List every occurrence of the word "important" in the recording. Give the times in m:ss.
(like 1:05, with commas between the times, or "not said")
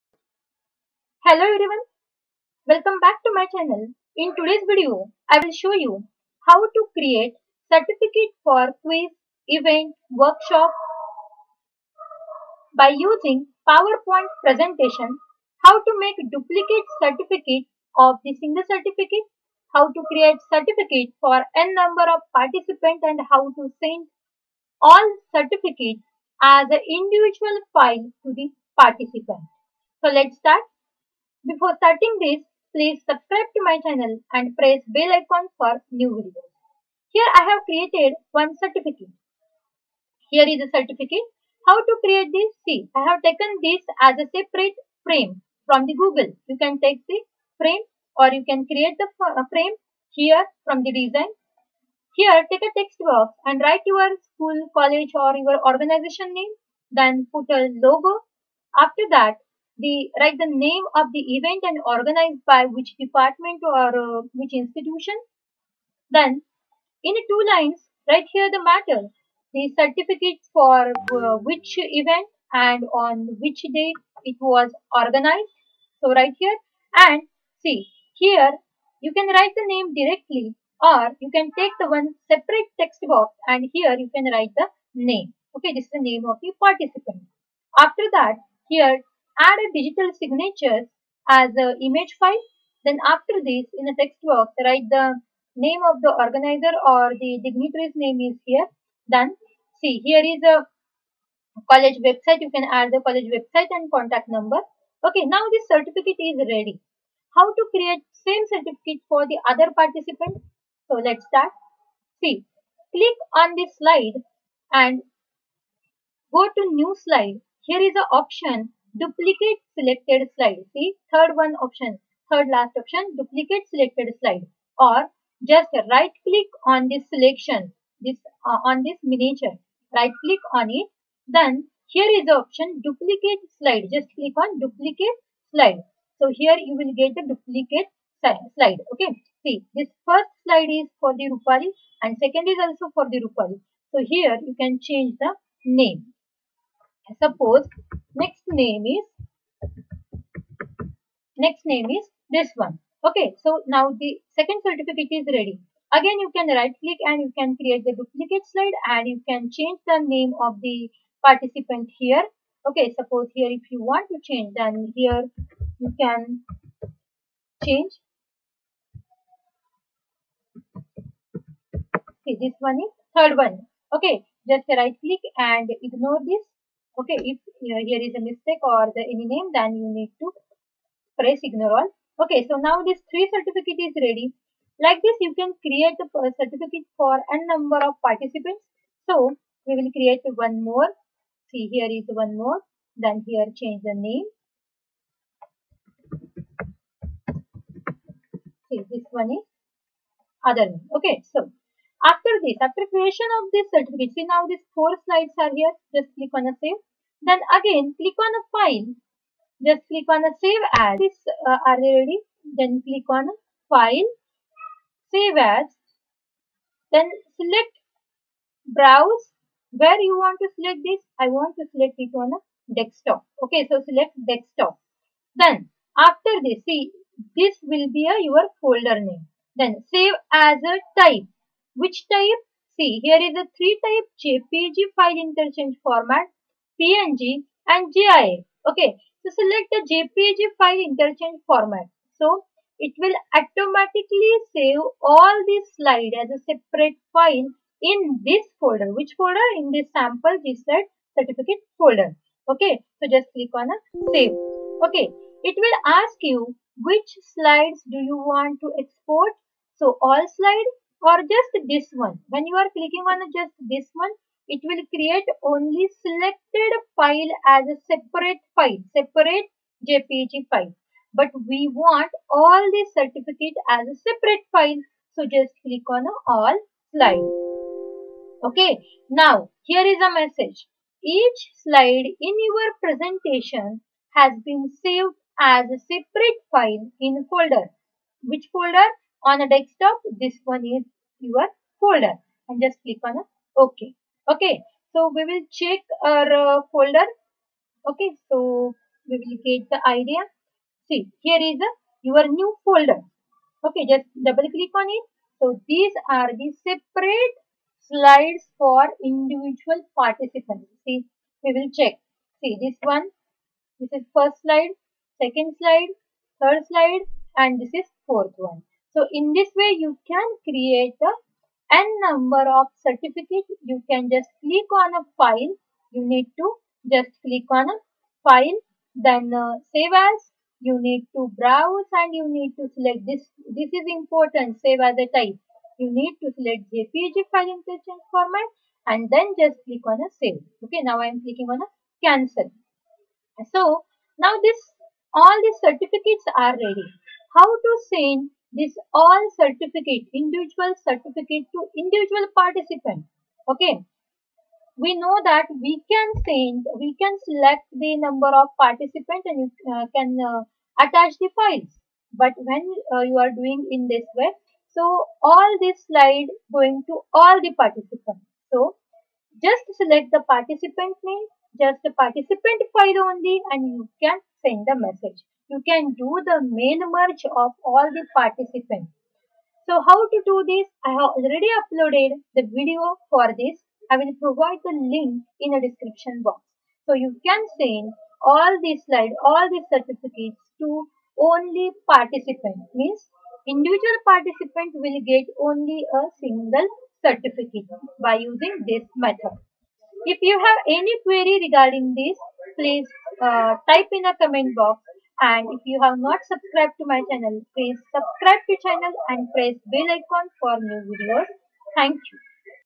5:33.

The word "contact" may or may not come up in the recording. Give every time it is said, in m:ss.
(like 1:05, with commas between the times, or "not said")
1:43.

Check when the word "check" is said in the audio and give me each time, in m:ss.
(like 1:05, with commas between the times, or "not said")
4:55, 5:11.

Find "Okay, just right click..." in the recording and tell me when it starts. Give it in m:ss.
2:53.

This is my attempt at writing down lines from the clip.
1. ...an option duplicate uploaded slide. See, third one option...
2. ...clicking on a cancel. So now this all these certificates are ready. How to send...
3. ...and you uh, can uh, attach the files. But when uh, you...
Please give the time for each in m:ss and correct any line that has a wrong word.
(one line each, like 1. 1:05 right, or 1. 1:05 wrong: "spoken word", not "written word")
1. 1:57 wrong: "selected", not "uploaded"
2. 5:41 right
3. 5:59 right.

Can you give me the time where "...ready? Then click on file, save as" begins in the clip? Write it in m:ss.
3:31.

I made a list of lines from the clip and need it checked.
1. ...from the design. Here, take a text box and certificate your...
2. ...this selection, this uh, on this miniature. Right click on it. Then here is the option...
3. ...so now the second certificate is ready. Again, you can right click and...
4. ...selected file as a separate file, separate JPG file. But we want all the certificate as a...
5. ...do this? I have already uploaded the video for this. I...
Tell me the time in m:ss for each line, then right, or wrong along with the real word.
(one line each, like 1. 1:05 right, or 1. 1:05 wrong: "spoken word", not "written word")
1. 0:50 wrong: "write", not "certificate"
2. 2:06 right
3. 2:33 right
4. 4:26 right
5. 6:20 right.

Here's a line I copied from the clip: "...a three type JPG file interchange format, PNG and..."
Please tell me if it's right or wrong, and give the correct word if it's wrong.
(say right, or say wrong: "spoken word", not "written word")
right.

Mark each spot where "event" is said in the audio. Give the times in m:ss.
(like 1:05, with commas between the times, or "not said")
0:09, 1:01, 1:11.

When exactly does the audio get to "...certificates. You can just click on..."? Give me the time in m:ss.
5:22.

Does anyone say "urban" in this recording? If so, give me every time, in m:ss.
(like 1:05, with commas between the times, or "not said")
not said.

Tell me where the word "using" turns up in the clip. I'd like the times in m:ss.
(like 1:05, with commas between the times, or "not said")
0:12, 6:38.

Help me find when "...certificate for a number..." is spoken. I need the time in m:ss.
3:06.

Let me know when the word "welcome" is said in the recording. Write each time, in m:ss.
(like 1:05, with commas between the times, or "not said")
0:02.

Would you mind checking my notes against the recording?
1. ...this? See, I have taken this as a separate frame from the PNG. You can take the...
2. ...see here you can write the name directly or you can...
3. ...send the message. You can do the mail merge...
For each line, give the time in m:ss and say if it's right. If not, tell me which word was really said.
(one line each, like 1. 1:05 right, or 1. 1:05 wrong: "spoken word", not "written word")
1. 0:42 wrong: "Google", not "PNG"
2. 1:17 right
3. 6:14 right.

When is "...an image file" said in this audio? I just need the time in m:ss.
1:31.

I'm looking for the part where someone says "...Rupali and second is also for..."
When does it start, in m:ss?
2:21.